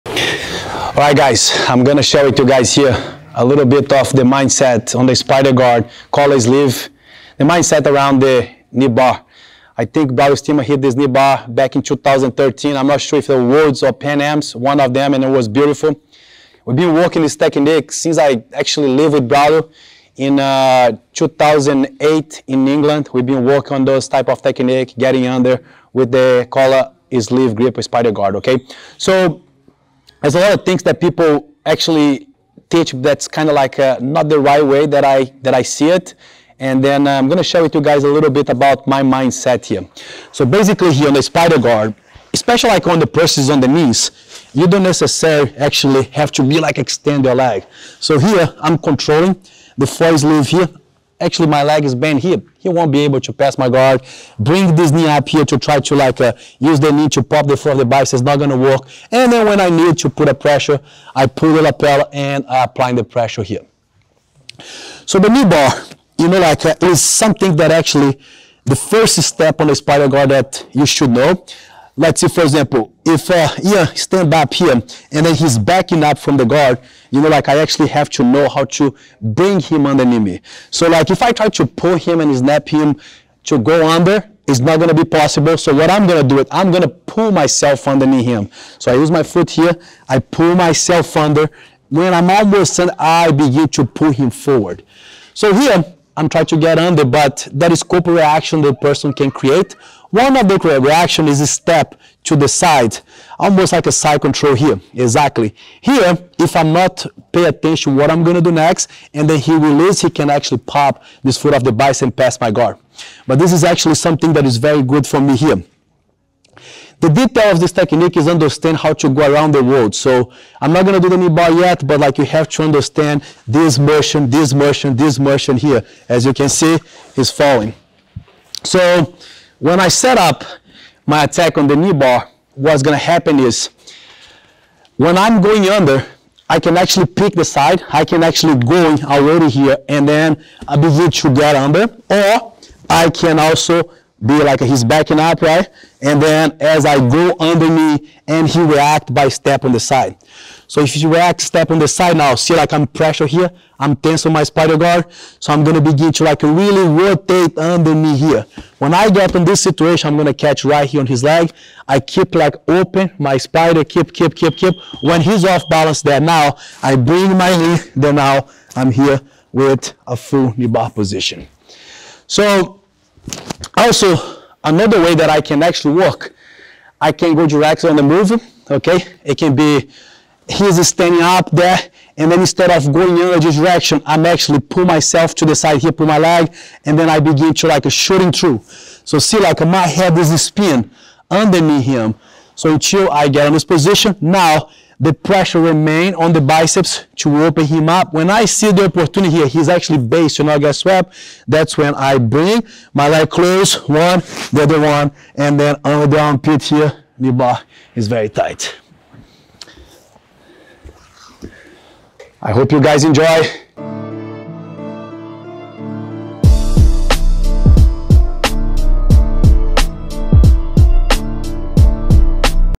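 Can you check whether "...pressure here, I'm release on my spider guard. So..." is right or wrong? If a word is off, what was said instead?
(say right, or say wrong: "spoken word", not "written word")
wrong: "tense", not "release".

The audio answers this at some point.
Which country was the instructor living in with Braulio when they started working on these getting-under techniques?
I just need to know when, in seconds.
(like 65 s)
22 s.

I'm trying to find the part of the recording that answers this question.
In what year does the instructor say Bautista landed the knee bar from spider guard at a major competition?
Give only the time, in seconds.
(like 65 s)
11 s.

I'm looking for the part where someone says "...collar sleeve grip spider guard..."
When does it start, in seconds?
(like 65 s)
26 s.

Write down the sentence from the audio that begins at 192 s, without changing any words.
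So until I get in this position, now the pressure remain on the biceps to open him up.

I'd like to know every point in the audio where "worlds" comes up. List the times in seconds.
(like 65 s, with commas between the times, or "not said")
13 s, 119 s.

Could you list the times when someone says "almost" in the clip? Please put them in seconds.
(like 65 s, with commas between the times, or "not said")
92 s, 103 s.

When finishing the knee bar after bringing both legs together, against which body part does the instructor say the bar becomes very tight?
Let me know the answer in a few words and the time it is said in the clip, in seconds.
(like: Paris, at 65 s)
The armpit, at 206 s.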